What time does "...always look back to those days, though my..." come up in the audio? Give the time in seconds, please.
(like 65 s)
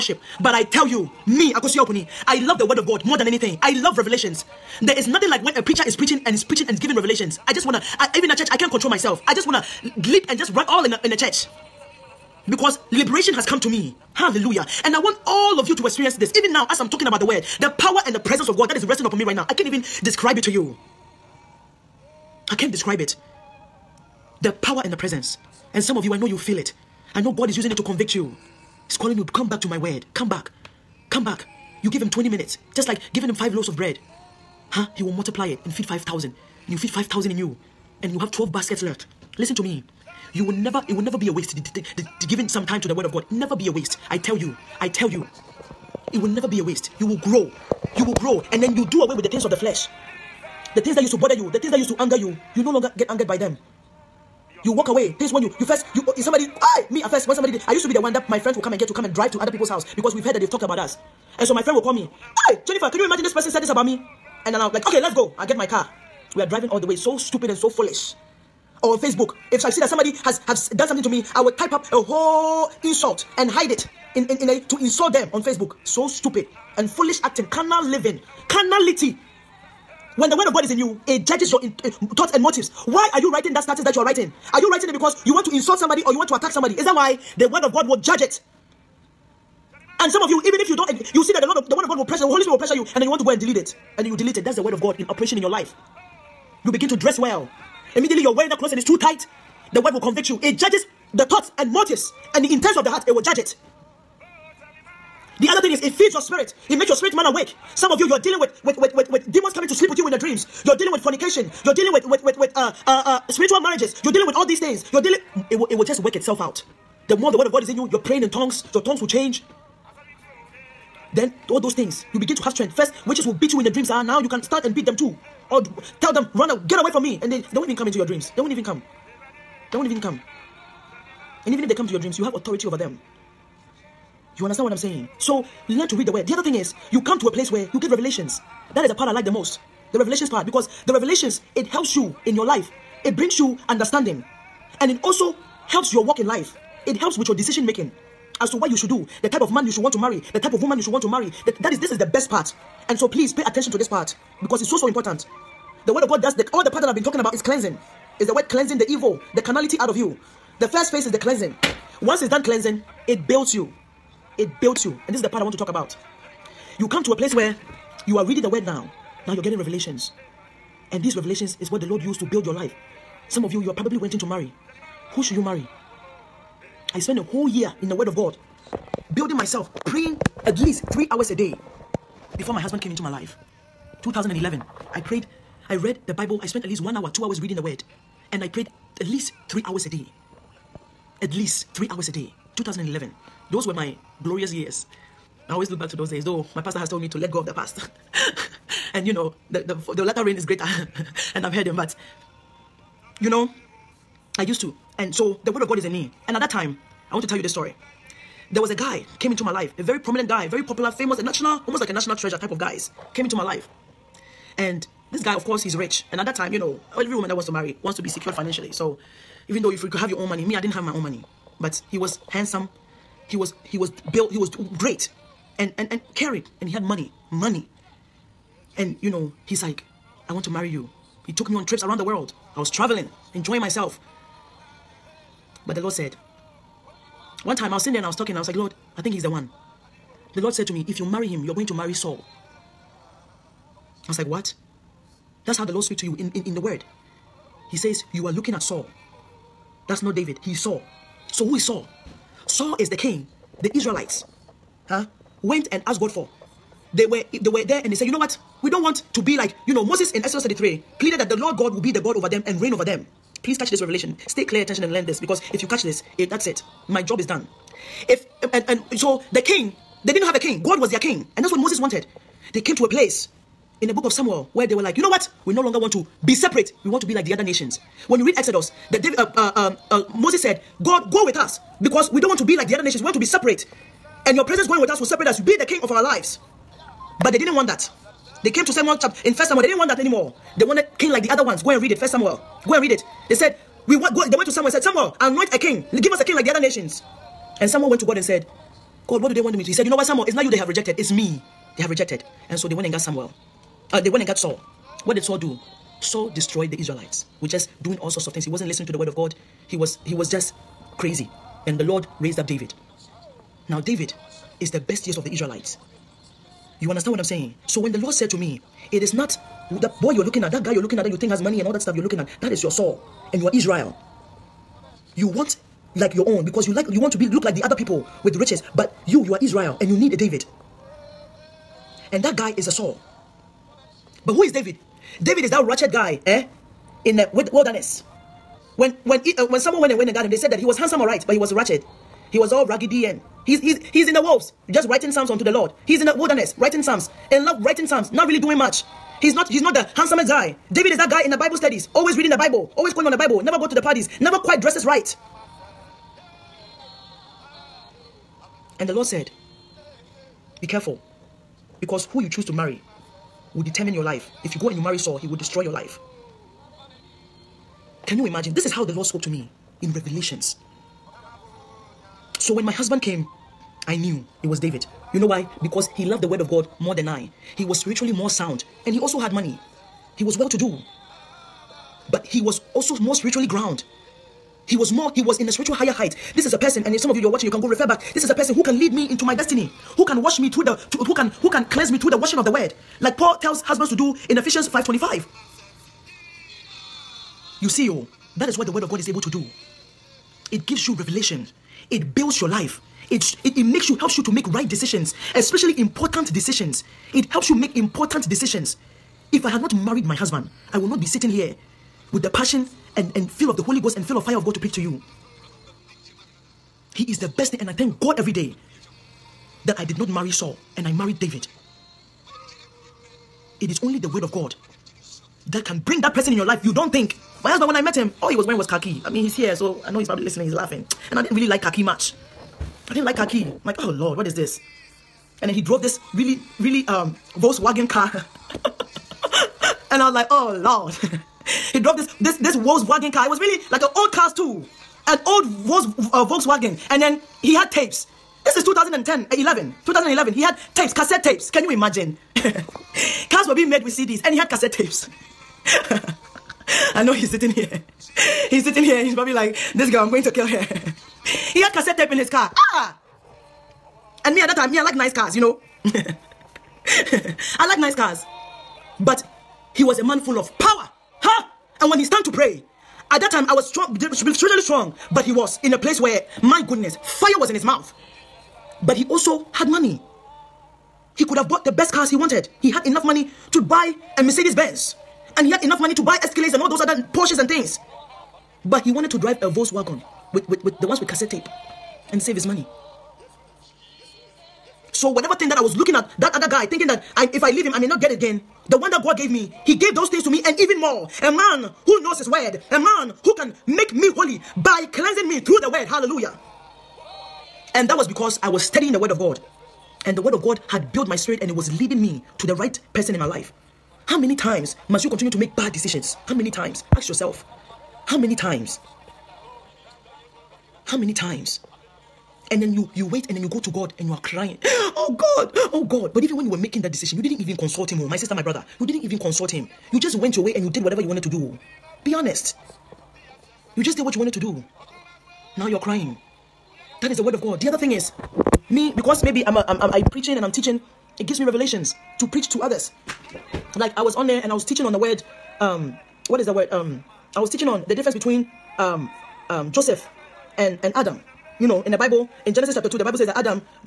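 195 s.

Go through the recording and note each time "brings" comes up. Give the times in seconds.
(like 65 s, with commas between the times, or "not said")
143 s, 425 s.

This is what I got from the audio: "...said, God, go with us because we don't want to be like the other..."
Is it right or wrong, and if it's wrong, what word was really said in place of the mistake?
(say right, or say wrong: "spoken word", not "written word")
right.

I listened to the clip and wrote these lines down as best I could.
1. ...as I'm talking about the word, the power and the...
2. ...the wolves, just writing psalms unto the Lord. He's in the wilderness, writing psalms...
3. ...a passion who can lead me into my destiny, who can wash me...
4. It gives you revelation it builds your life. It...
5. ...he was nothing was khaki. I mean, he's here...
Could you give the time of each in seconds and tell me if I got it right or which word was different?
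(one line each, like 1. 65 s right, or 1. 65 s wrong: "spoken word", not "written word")
1. 16 s right
2. 344 s right
3. 388 s wrong: "person", not "passion"
4. 400 s right
5. 428 s wrong: "wearing", not "nothing".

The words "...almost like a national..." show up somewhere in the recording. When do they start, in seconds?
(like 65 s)
211 s.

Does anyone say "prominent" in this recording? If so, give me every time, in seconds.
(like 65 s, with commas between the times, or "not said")
209 s.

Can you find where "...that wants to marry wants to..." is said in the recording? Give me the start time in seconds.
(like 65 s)
217 s.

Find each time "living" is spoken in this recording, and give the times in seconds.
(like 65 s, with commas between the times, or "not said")
77 s.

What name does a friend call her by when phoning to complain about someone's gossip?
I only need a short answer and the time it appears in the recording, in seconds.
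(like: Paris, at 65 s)
Jennifer, at 62 s.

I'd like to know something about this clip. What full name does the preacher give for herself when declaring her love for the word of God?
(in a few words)
Akosuya Opuni.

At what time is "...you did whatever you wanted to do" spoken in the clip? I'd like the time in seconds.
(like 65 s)
530 s.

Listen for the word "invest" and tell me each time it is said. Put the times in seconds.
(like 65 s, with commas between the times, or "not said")
not said.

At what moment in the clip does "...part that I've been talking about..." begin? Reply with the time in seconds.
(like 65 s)
156 s.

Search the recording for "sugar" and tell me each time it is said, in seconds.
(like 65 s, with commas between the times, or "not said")
not said.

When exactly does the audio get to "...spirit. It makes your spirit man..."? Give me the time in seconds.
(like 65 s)
106 s.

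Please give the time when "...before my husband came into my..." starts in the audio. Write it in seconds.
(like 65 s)
182 s.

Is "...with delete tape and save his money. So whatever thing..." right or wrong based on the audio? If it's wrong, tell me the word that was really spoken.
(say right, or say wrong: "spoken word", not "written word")
wrong: "cassette", not "delete".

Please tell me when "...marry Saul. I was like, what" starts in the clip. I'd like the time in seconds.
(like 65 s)
241 s.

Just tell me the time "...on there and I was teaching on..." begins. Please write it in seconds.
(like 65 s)
544 s.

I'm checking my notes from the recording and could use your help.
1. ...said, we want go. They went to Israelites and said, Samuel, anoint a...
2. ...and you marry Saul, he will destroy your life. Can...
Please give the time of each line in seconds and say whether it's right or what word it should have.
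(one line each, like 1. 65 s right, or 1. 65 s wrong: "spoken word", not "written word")
1. 293 s wrong: "Samuel", not "Israelites"
2. 364 s right.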